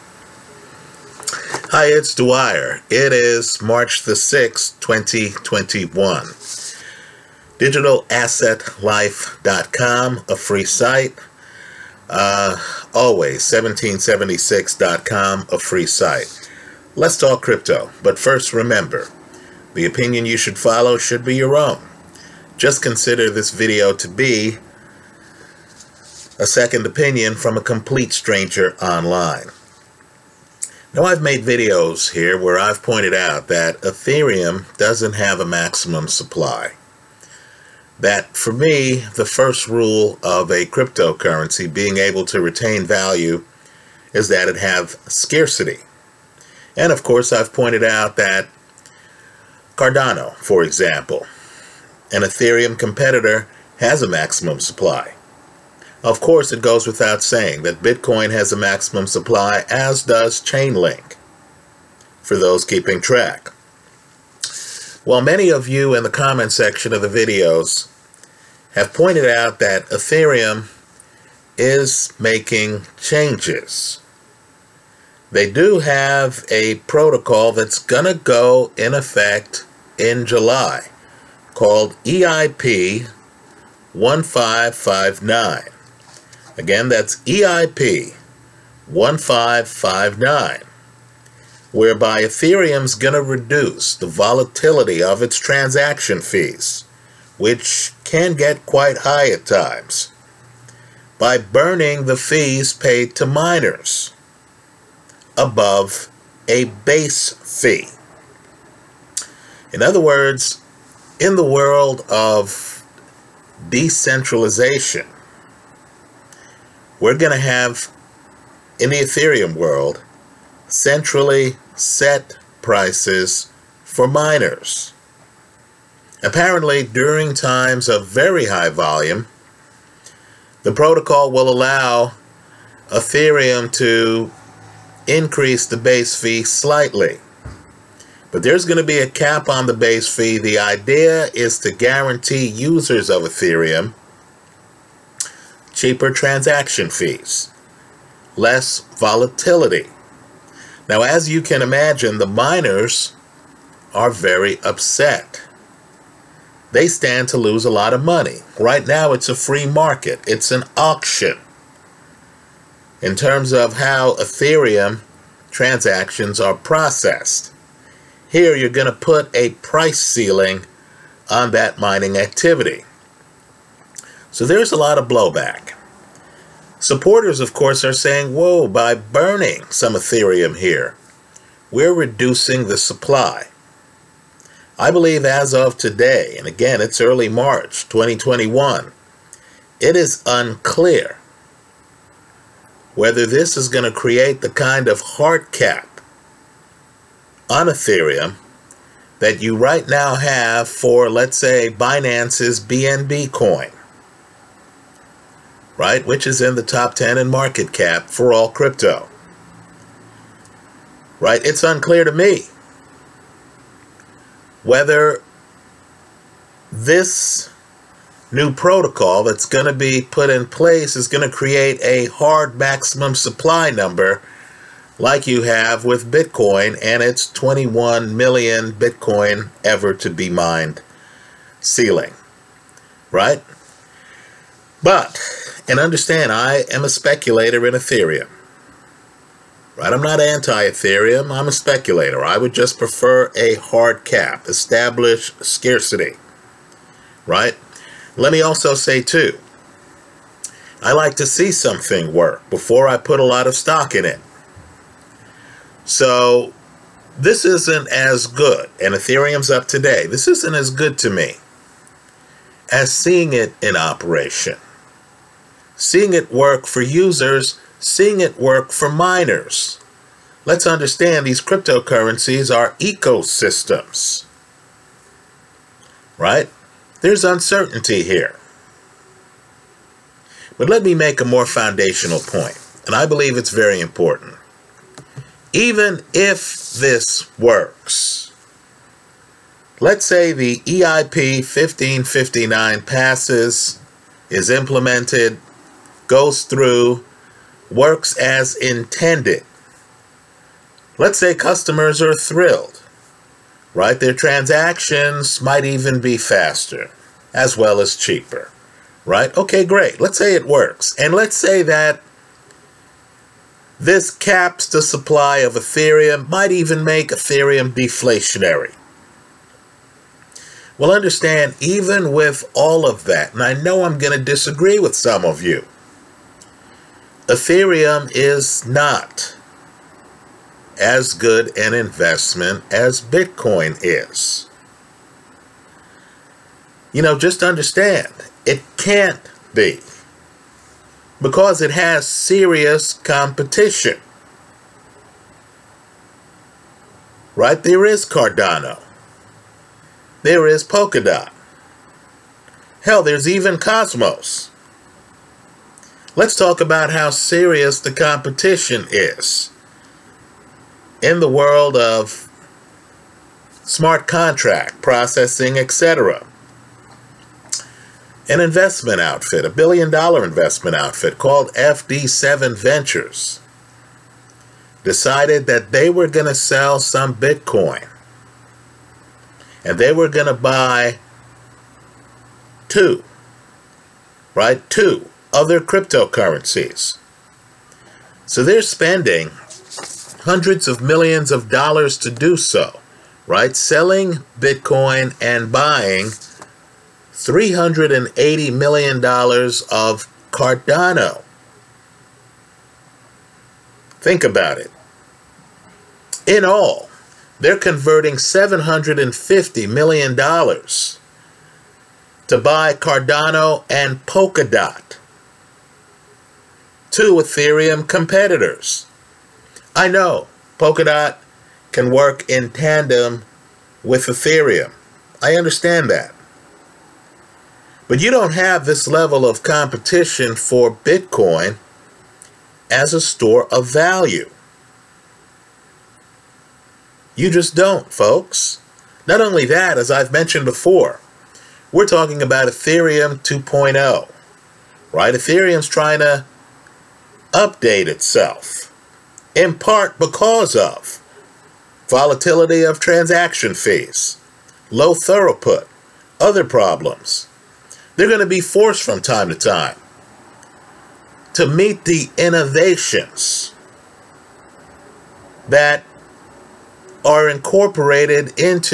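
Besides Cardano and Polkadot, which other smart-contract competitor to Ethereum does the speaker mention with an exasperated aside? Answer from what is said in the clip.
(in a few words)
Cosmos.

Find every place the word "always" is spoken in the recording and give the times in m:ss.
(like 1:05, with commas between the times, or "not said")
0:12.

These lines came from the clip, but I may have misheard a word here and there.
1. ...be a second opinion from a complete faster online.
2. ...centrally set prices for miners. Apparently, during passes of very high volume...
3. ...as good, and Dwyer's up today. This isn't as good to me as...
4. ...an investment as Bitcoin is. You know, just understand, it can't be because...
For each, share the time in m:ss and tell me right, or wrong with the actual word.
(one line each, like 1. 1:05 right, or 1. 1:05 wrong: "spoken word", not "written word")
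1. 0:24 wrong: "stranger", not "faster"
2. 2:00 wrong: "times", not "passes"
3. 4:17 wrong: "Ethereum", not "Dwyer"
4. 5:31 right.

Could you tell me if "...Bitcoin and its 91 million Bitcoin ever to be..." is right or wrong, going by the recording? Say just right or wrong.
wrong.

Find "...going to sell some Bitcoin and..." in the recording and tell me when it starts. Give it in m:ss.
6:16.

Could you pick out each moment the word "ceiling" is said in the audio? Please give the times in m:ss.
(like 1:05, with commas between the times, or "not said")
2:49, 3:51.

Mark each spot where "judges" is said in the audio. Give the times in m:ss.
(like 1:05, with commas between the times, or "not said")
not said.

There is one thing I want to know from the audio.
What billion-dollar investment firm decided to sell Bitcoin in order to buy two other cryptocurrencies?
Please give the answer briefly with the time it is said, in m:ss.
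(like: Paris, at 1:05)
FD7 Ventures, at 6:11.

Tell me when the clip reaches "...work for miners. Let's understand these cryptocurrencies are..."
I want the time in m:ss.
4:28.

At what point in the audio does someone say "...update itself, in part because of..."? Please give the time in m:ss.
7:27.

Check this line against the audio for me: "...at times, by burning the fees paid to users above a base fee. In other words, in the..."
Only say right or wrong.
wrong.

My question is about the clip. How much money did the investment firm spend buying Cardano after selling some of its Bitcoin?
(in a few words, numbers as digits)
$380 million.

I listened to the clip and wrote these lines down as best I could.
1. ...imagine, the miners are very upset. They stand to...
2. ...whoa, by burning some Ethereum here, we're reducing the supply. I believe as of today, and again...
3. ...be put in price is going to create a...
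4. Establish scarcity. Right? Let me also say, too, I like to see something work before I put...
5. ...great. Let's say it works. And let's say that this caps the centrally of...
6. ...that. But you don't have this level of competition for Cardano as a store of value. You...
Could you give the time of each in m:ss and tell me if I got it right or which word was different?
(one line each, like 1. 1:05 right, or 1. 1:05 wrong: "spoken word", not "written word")
1. 2:31 right
2. 2:58 right
3. 3:39 wrong: "place", not "price"
4. 4:04 right
5. 5:09 wrong: "supply", not "centrally"
6. 7:05 wrong: "Bitcoin", not "Cardano".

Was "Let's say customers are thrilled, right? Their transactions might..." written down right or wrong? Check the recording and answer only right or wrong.
right.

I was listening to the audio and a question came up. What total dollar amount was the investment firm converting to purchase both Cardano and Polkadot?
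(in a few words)
$750 million.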